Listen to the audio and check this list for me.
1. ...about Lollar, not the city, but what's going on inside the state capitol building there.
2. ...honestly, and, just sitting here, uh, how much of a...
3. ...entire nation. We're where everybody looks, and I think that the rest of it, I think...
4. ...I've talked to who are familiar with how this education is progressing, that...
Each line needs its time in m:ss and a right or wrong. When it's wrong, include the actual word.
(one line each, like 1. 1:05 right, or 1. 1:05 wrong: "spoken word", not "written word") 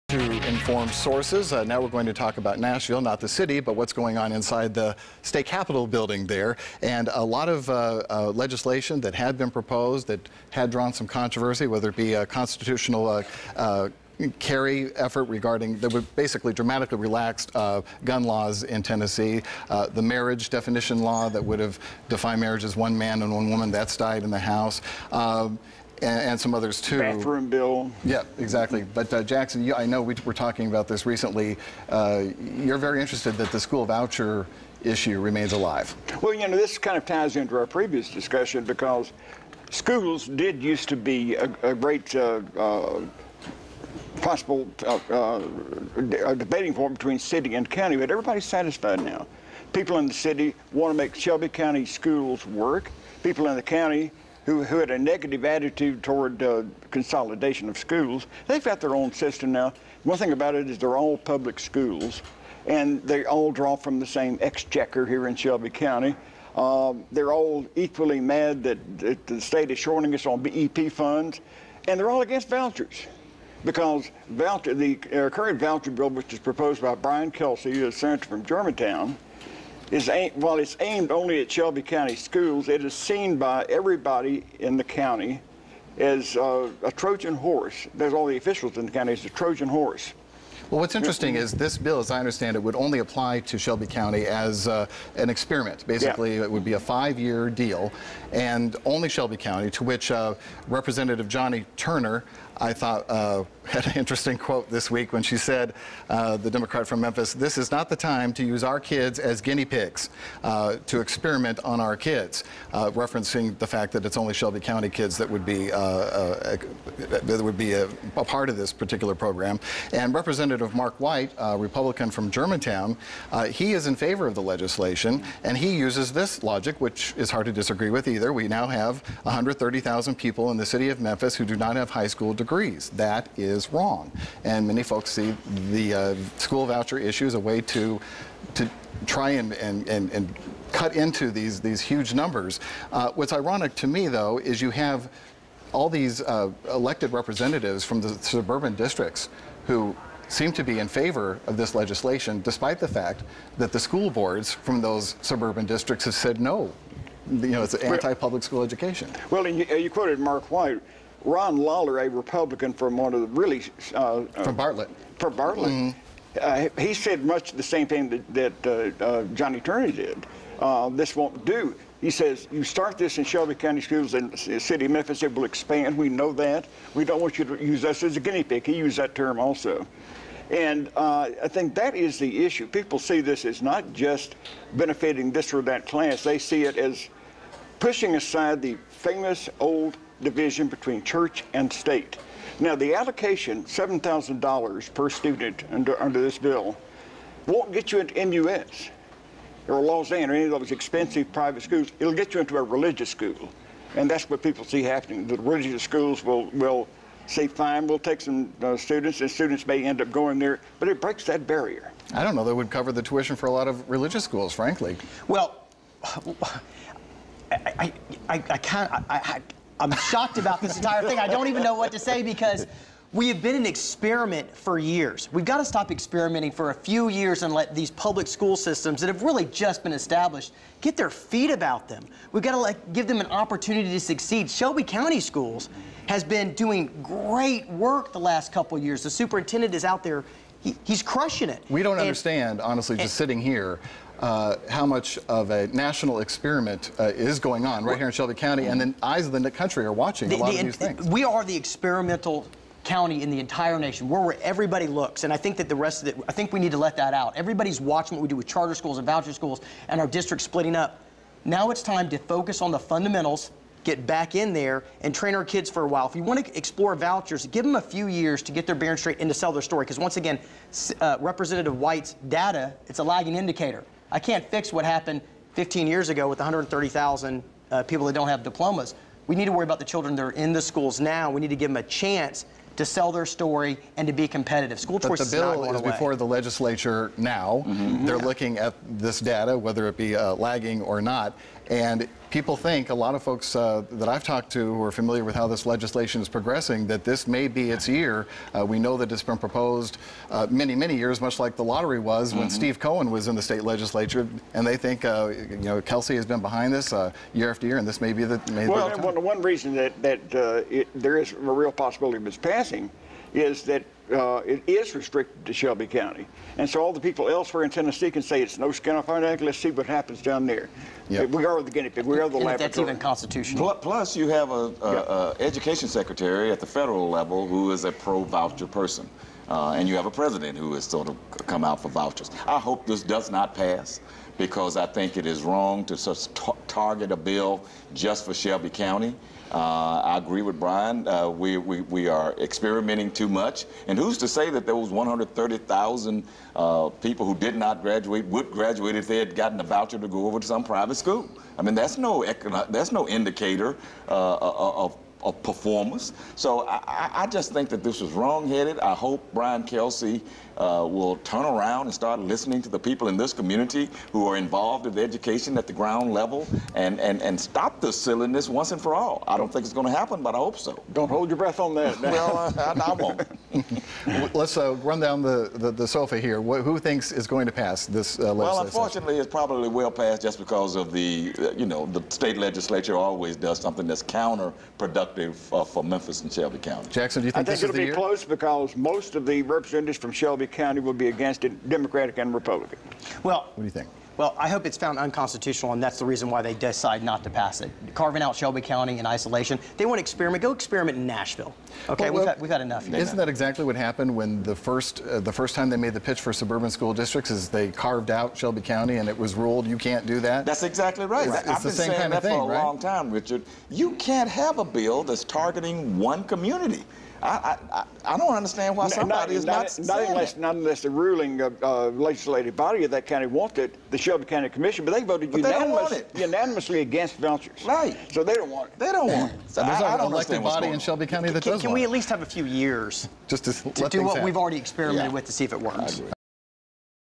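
1. 0:02 wrong: "Nashville", not "Lollar"
2. 4:02 right
3. 4:13 right
4. 4:54 wrong: "legislation", not "education".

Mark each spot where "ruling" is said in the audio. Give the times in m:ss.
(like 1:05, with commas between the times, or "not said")
7:00.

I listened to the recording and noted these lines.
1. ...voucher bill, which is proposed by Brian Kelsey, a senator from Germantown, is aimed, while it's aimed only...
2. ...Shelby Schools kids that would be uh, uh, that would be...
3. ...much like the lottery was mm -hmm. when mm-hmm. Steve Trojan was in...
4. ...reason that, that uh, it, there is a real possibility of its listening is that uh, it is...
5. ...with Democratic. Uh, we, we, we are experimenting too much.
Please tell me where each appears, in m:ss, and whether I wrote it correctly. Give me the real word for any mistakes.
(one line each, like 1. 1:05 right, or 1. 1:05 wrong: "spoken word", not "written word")
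1. 1:15 right
2. 1:54 wrong: "County", not "Schools"
3. 5:01 wrong: "Cohen", not "Trojan"
4. 5:09 wrong: "passing", not "listening"
5. 5:40 wrong: "Brian", not "Democratic".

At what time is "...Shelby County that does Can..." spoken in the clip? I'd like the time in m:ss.
7:10.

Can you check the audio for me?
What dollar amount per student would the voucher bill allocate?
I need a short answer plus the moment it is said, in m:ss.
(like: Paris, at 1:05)
$7,000, at 3:13.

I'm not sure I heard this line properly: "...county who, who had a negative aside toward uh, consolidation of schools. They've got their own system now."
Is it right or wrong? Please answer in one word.
wrong.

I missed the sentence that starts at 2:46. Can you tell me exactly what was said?
uh, he said much the same thing that, that uh, uh Johnnie Turner did.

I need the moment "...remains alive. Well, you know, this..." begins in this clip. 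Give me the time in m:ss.
0:35.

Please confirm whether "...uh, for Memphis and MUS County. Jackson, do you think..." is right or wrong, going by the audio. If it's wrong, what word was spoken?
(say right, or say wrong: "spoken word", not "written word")
wrong: "Shelby", not "MUS".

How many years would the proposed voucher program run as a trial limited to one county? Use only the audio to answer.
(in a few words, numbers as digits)
5.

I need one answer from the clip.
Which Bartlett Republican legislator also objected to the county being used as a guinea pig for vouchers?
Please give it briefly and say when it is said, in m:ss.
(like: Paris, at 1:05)
Ron Lollar, at 2:41.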